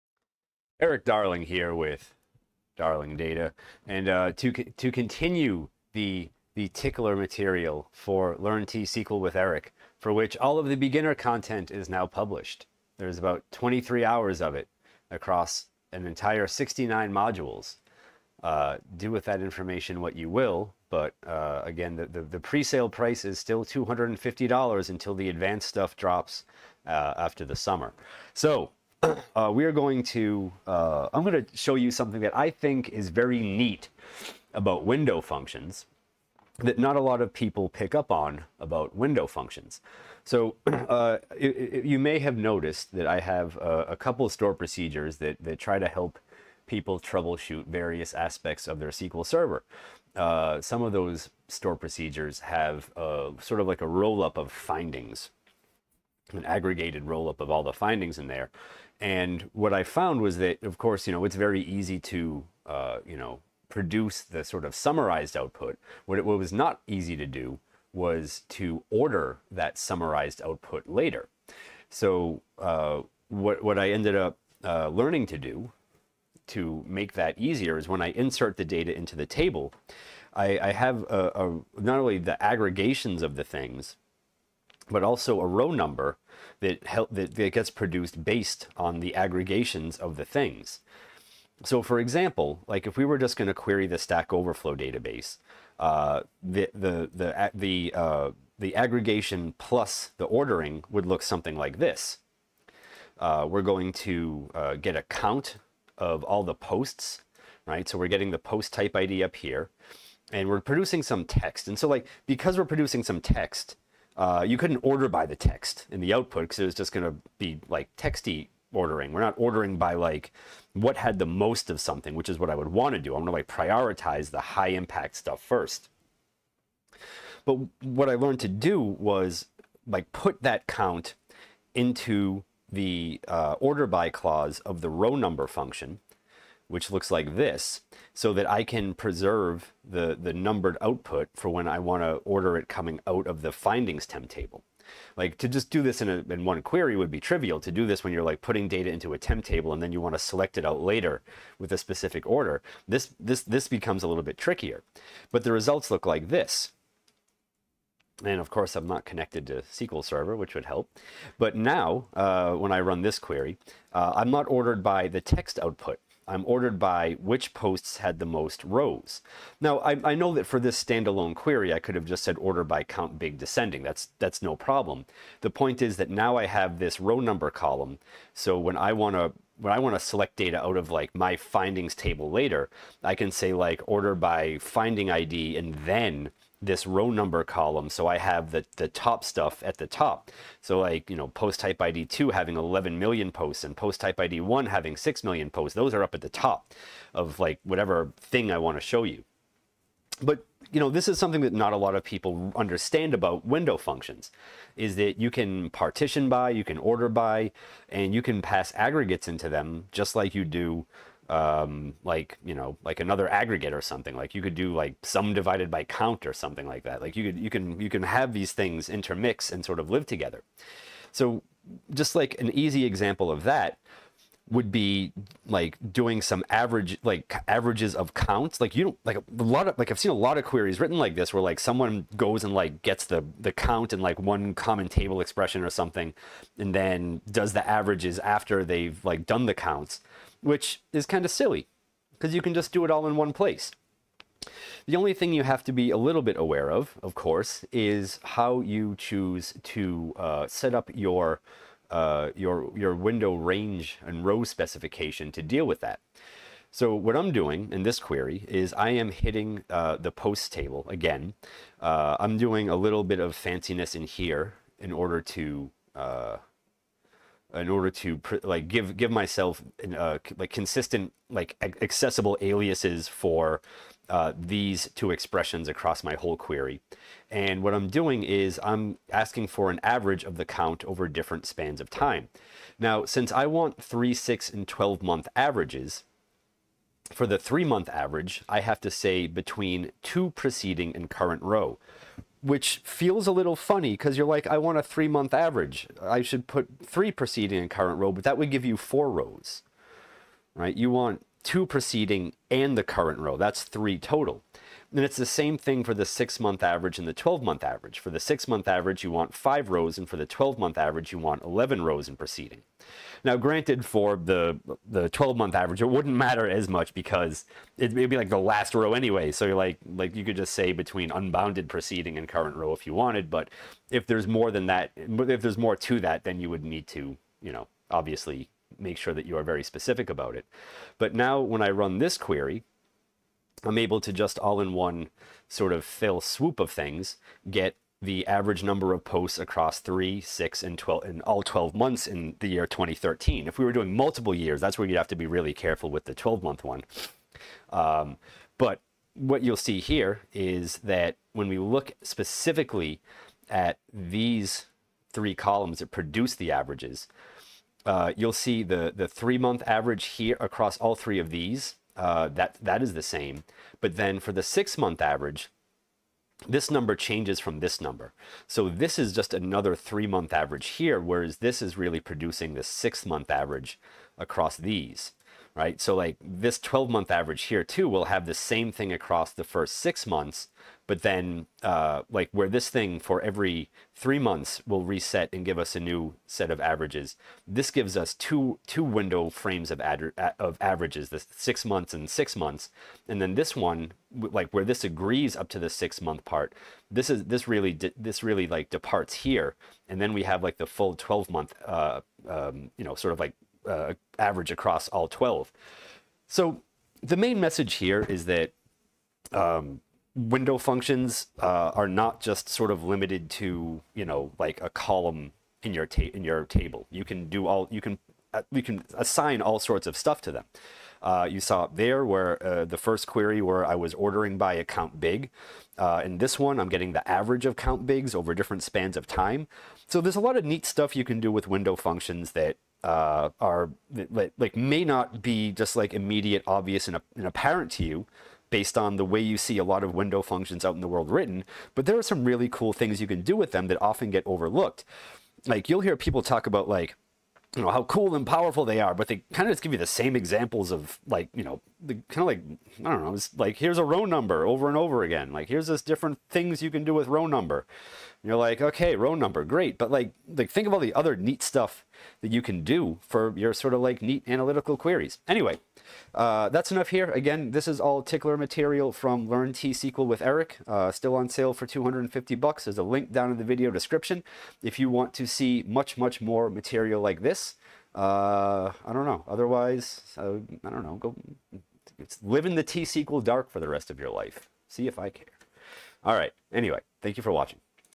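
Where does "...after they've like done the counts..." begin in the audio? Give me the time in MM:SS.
03:58.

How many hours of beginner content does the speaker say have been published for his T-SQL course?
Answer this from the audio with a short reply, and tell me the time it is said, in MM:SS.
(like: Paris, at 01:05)
23, at 00:13.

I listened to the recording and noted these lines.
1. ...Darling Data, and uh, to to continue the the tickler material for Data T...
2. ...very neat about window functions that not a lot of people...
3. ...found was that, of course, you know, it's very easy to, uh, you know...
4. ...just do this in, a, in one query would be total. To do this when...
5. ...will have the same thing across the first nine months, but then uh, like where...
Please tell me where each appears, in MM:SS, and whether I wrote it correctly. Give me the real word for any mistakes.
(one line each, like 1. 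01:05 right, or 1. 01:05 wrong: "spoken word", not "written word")
1. 00:02 wrong: "Learn", not "Data"
2. 00:33 right
3. 00:59 right
4. 02:25 wrong: "trivial", not "total"
5. 06:17 wrong: "six", not "nine".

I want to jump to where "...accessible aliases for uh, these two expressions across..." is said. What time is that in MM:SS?
04:31.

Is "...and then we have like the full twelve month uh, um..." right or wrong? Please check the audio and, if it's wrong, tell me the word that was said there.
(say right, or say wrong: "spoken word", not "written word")
right.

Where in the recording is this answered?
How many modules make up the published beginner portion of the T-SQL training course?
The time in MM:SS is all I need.
00:16.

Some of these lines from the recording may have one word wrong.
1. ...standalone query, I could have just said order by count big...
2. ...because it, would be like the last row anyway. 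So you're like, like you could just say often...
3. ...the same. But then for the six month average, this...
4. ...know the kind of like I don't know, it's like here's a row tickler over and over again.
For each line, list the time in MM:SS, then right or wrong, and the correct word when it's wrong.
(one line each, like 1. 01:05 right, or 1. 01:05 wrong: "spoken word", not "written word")
1. 02:50 right
2. 05:16 wrong: "between", not "often"
3. 06:02 right
4. 07:31 wrong: "number", not "tickler".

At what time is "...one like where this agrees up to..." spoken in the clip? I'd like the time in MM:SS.
06:33.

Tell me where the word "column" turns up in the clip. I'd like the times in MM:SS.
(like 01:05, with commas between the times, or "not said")
02:57, 03:07, 05:55, 06:54.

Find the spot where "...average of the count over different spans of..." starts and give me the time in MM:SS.
04:39.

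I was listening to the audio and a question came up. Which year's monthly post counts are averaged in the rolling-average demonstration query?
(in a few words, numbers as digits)
2013.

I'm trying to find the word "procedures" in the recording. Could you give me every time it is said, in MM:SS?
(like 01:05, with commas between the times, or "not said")
00:44, 00:51.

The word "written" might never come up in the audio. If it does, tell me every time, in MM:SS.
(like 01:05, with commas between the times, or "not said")
03:50, 07:21.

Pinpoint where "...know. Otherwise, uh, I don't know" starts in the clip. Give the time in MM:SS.
07:59.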